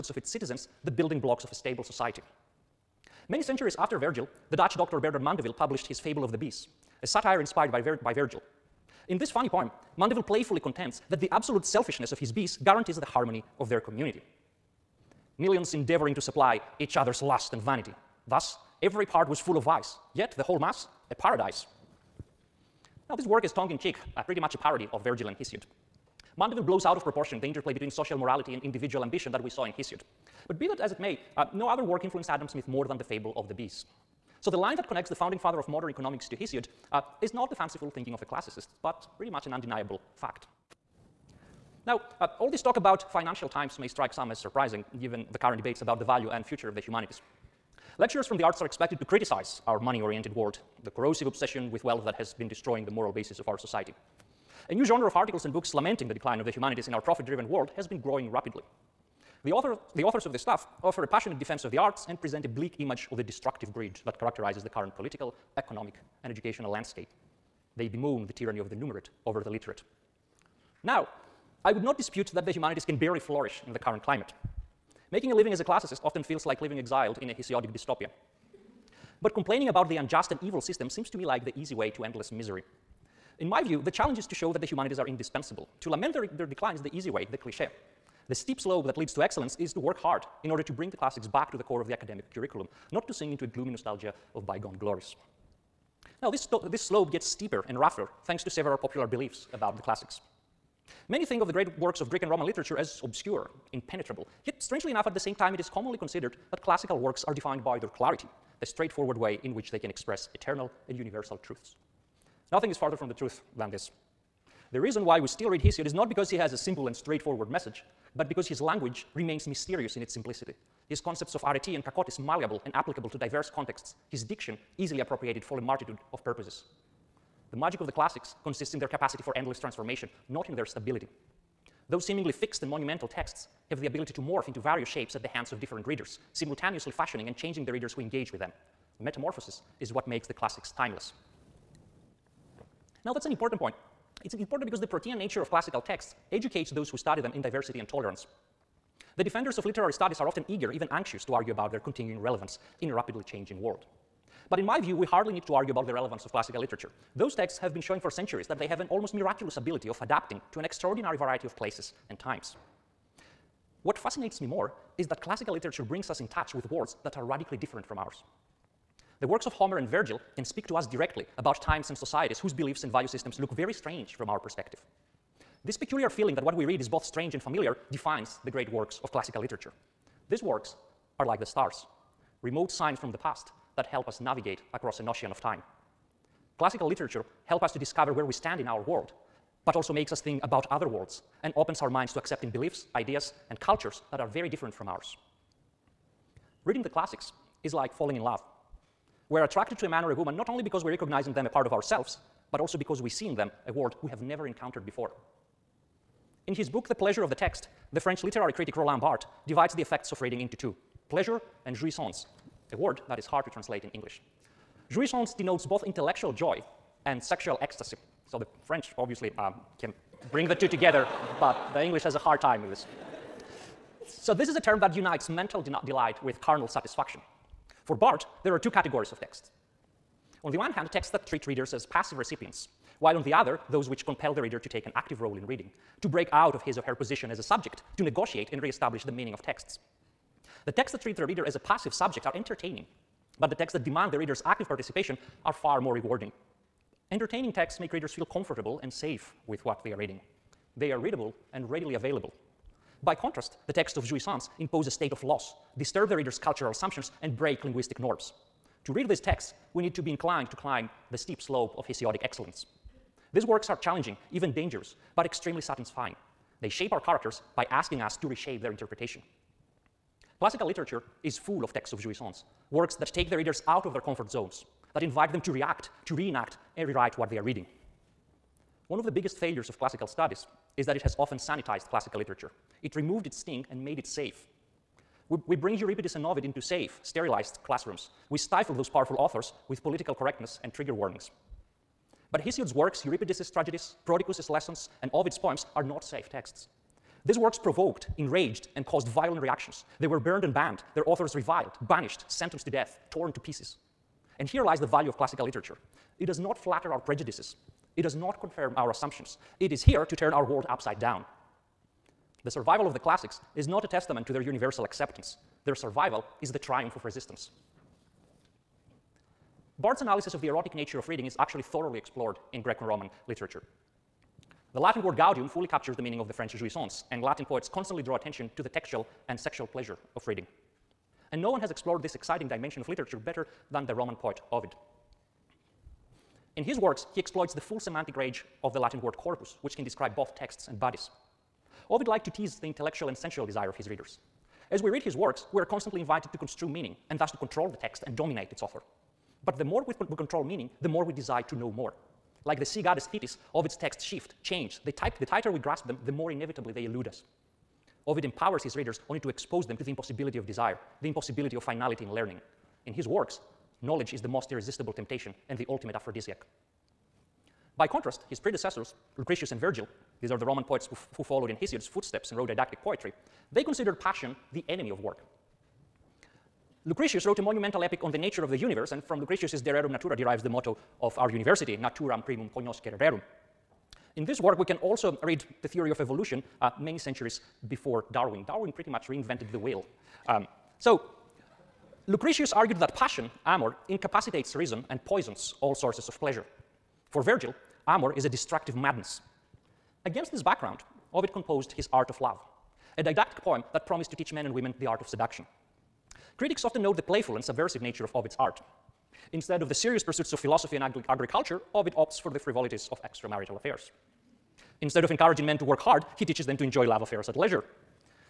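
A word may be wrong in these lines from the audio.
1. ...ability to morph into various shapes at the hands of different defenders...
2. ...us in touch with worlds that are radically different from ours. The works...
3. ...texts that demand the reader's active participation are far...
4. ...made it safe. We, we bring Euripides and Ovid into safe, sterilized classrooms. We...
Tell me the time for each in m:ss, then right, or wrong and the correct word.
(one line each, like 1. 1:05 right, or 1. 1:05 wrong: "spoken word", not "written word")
1. 2:13 wrong: "readers", not "defenders"
2. 2:46 right
3. 4:03 right
4. 4:43 right.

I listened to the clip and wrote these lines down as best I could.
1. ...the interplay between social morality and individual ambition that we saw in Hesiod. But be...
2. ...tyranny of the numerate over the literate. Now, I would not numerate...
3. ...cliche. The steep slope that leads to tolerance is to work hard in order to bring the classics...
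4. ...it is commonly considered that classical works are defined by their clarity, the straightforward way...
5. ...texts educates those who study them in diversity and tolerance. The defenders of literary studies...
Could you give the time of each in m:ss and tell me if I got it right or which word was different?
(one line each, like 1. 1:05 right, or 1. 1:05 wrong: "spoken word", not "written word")
1. 0:27 right
2. 1:08 wrong: "dispute", not "numerate"
3. 1:27 wrong: "excellence", not "tolerance"
4. 1:45 right
5. 2:25 right.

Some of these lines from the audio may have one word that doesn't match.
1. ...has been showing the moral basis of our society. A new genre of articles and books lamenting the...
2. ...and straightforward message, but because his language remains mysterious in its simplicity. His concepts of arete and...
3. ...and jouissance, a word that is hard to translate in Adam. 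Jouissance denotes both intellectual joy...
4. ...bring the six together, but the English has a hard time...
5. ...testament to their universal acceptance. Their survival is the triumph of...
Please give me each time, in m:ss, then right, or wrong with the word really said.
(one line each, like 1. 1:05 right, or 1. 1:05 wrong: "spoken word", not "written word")
1. 0:52 wrong: "destroying", not "showing"
2. 1:56 right
3. 3:31 wrong: "English", not "Adam"
4. 3:40 wrong: "two", not "six"
5. 5:13 right.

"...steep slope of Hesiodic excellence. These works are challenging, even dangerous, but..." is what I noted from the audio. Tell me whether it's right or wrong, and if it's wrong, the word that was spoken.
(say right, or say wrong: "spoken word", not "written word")
right.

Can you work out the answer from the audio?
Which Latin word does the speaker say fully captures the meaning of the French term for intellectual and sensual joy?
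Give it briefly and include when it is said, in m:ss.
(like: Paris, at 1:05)
gaudium, at 5:25.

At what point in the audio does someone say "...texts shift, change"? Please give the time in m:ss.
5:53.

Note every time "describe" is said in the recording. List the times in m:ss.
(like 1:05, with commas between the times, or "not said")
5:39.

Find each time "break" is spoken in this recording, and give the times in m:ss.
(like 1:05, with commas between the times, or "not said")
3:56, 4:17.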